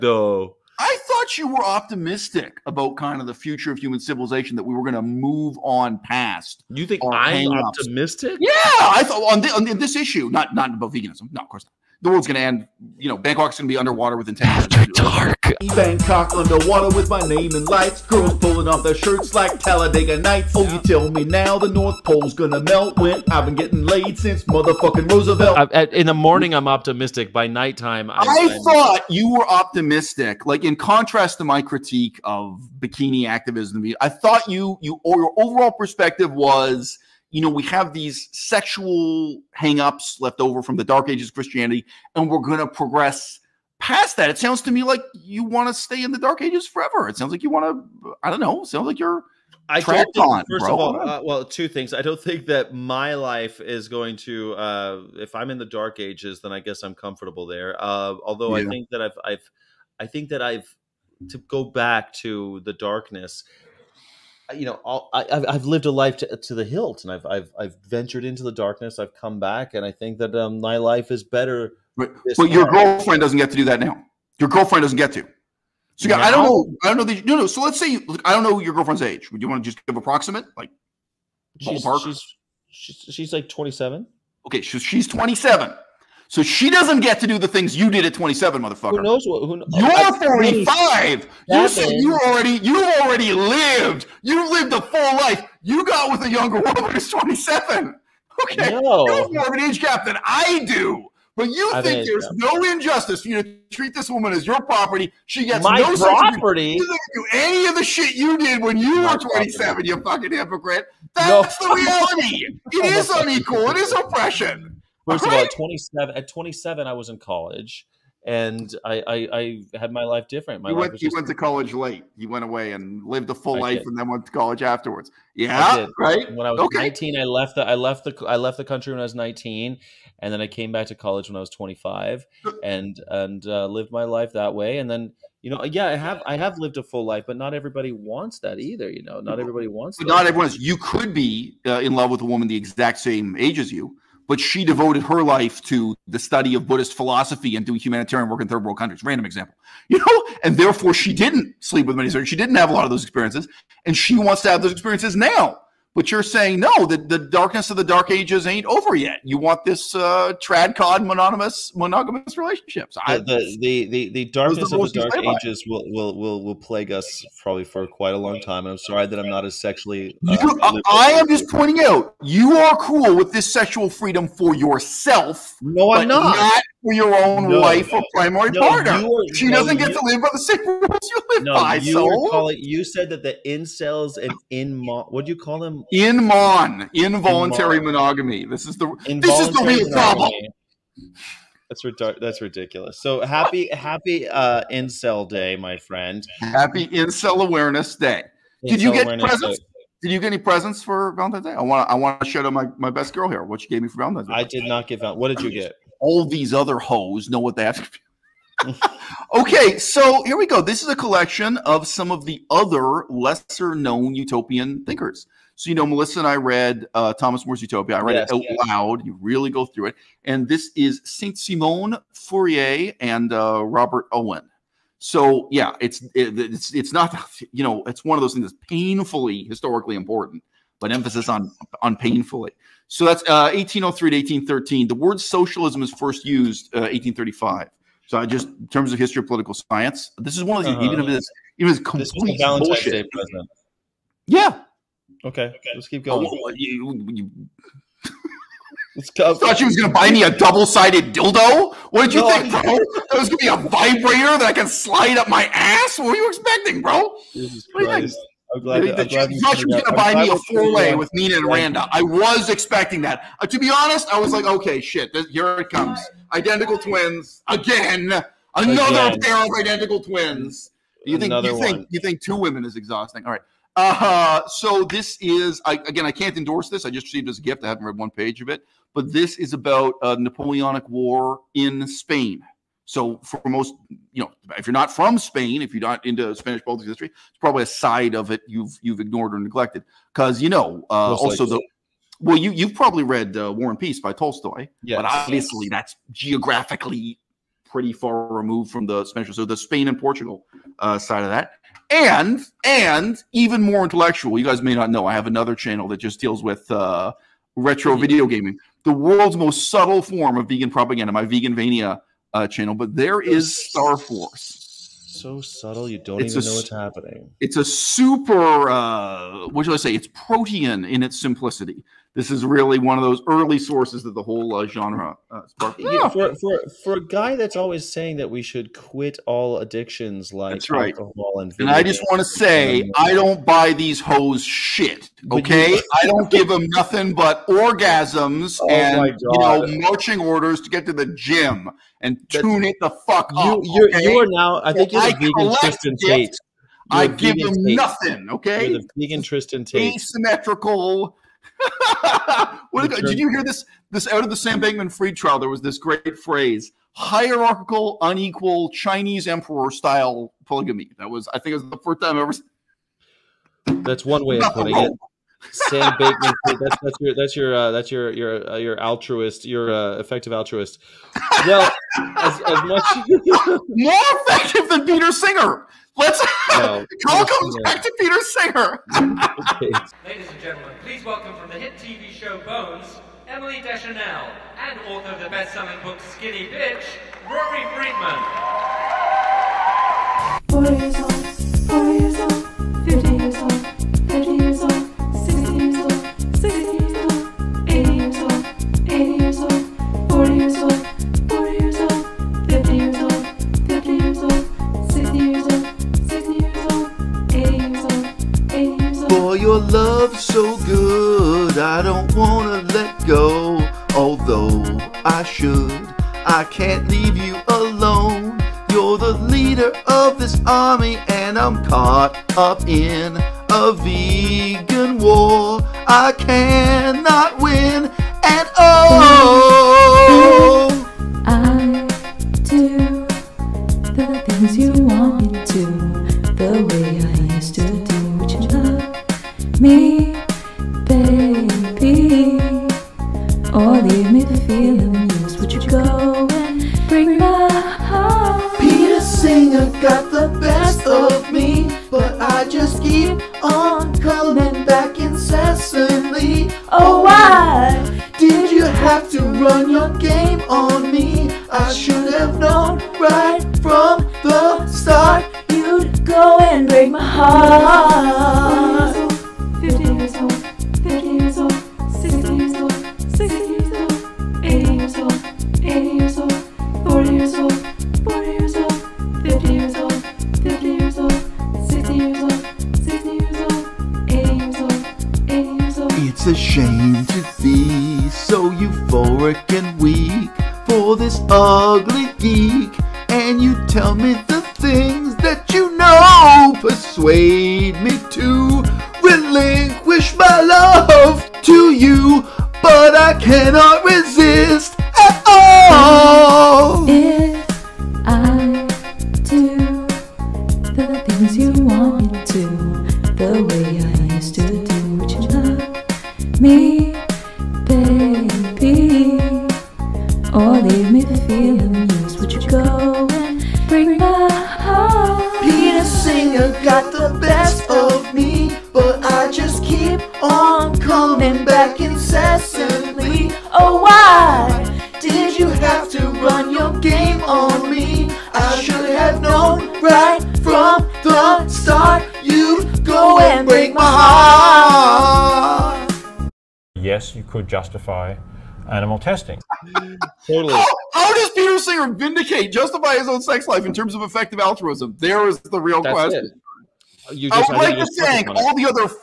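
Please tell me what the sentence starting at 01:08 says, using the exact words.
I've come back, and I think that um, my life is better.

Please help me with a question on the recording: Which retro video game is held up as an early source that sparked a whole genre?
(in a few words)
Star Force.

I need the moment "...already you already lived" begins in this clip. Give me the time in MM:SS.
01:32.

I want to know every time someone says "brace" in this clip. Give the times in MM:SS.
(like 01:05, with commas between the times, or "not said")
not said.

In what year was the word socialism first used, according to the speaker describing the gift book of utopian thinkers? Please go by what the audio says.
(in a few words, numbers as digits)
1835.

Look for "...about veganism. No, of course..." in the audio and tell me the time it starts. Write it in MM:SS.
00:10.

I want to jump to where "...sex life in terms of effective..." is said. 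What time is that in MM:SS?
09:13.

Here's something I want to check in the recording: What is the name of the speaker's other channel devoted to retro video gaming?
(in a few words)
Veganvania.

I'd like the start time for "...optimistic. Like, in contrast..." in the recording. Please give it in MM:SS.
00:29.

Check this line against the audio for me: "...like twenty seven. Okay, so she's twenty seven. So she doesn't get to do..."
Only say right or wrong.
right.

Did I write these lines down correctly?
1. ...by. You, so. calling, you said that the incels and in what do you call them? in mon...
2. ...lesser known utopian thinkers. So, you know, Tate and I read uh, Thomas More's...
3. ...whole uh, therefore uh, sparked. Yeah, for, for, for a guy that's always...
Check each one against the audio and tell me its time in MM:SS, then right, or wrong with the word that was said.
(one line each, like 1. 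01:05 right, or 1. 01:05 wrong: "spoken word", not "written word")
1. 03:01 right
2. 03:33 wrong: "Melissa", not "Tate"
3. 05:24 wrong: "genre", not "therefore".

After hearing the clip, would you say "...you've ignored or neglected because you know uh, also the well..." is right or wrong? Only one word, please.
right.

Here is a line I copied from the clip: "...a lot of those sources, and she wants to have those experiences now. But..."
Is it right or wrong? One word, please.
wrong.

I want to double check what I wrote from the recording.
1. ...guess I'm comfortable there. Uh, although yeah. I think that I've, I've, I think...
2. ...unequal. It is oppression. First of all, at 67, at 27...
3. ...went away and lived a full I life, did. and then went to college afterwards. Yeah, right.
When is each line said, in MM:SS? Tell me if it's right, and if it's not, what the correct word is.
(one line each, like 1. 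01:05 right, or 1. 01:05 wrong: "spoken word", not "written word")
1. 00:56 right
2. 01:53 wrong: "27", not "67"
3. 02:02 right.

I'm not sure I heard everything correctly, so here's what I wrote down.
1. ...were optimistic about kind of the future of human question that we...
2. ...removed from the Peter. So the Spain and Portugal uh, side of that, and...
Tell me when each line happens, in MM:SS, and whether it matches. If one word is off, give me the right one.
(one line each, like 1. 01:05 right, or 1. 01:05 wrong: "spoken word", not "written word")
1. 00:01 wrong: "civilization", not "question"
2. 04:58 wrong: "Spanish", not "Peter".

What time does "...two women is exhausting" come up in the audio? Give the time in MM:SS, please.
04:32.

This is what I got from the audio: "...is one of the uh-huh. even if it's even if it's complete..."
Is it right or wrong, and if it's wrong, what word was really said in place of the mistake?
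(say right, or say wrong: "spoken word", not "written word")
right.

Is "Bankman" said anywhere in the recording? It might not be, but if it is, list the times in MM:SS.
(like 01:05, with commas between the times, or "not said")
05:54, 06:05.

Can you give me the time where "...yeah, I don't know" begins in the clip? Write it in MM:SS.
01:16.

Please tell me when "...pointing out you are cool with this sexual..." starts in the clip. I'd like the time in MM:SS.
02:51.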